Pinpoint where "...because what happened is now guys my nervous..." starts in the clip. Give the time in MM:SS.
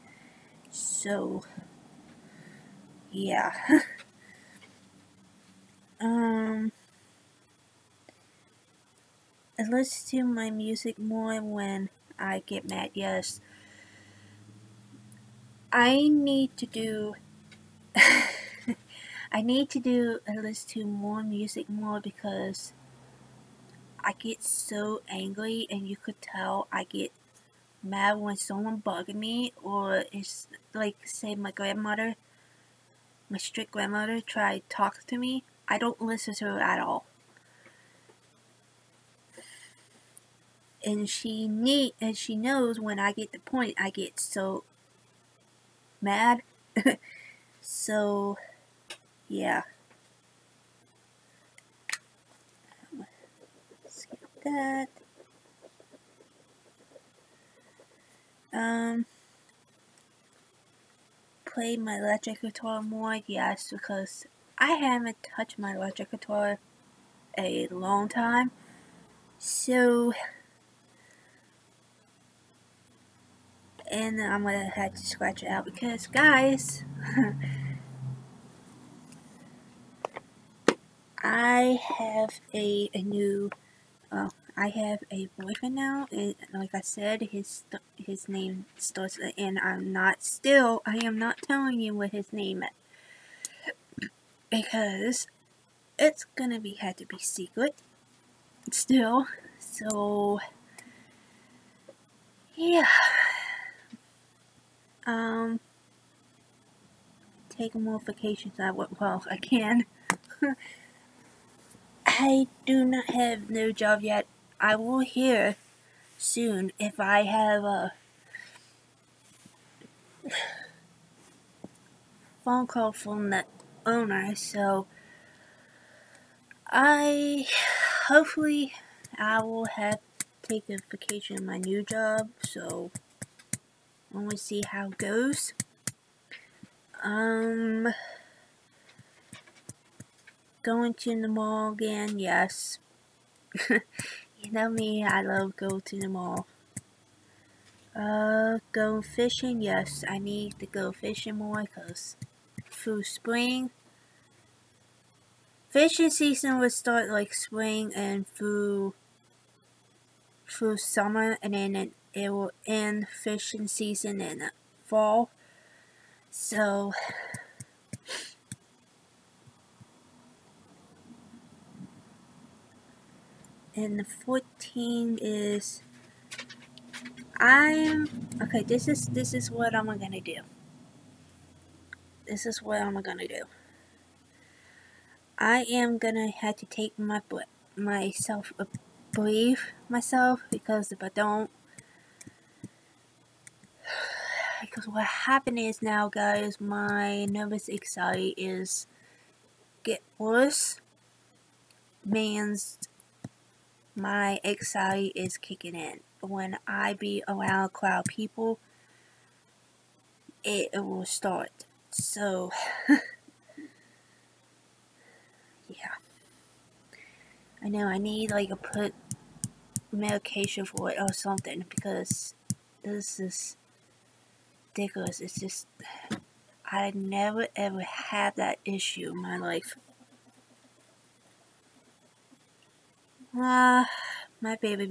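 03:14.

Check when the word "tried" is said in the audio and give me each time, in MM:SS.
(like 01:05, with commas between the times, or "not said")
00:34.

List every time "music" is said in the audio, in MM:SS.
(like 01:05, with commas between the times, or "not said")
00:10, 00:21.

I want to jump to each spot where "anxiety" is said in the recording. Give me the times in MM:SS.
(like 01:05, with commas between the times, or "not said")
03:17, 03:24.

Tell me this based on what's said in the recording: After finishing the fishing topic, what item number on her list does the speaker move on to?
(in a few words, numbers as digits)
14.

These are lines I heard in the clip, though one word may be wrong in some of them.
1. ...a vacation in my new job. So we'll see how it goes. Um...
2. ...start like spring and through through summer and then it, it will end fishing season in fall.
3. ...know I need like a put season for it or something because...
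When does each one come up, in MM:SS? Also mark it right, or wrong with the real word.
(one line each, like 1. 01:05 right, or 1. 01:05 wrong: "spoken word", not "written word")
1. 02:10 right
2. 02:36 right
3. 03:37 wrong: "medication", not "season".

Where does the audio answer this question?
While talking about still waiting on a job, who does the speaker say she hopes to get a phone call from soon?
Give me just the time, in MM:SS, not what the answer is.
02:03.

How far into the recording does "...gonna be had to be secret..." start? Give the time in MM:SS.
01:36.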